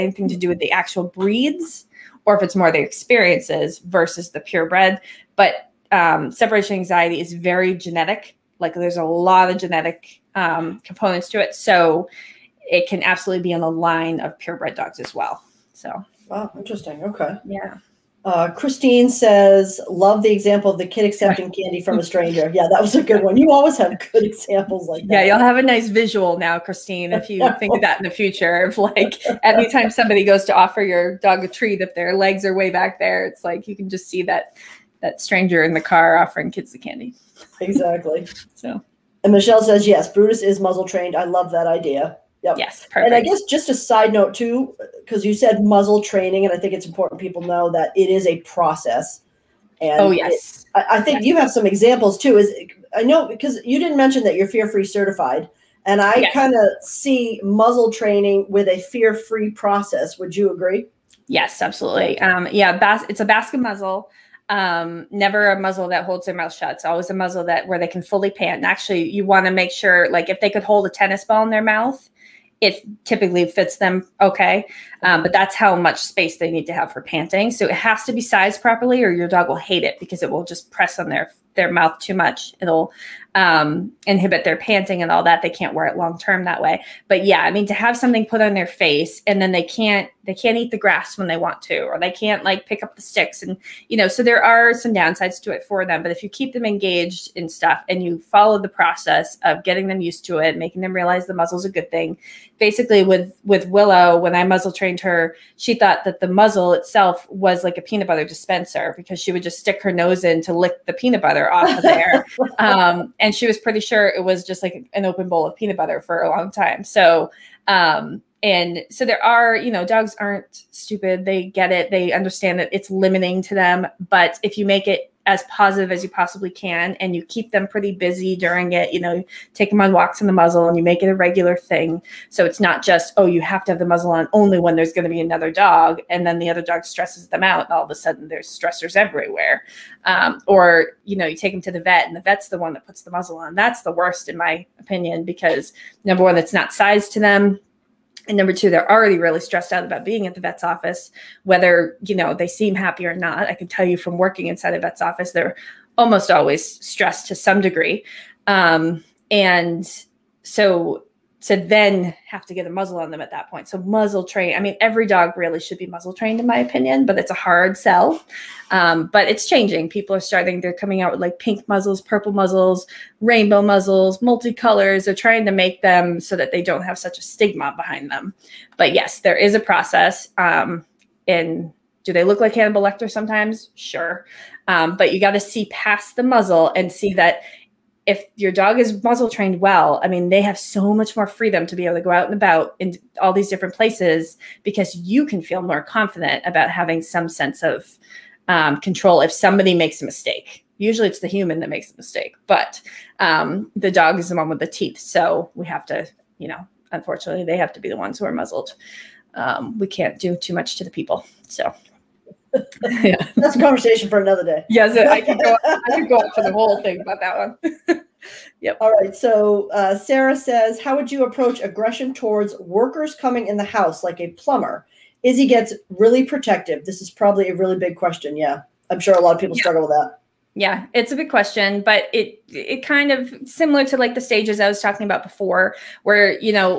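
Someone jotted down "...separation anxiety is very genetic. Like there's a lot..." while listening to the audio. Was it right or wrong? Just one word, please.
right.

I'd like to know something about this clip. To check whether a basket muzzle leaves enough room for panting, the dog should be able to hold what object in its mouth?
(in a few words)
a tennis ball.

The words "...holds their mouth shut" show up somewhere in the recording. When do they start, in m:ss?
1:06.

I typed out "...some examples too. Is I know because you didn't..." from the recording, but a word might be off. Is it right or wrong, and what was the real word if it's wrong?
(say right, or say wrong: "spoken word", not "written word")
right.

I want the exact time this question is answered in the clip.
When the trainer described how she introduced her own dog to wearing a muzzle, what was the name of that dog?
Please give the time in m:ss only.
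1:43.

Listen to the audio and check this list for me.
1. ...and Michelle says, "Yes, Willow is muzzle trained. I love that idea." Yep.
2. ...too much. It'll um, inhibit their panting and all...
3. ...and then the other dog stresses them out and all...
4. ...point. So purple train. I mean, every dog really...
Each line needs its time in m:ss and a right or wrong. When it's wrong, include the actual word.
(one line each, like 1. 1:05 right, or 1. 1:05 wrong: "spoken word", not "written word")
1. 0:39 wrong: "Brutus", not "Willow"
2. 1:21 right
3. 2:16 right
4. 2:43 wrong: "muzzle", not "purple".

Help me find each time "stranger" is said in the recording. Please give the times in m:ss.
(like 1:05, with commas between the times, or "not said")
0:22, 0:35.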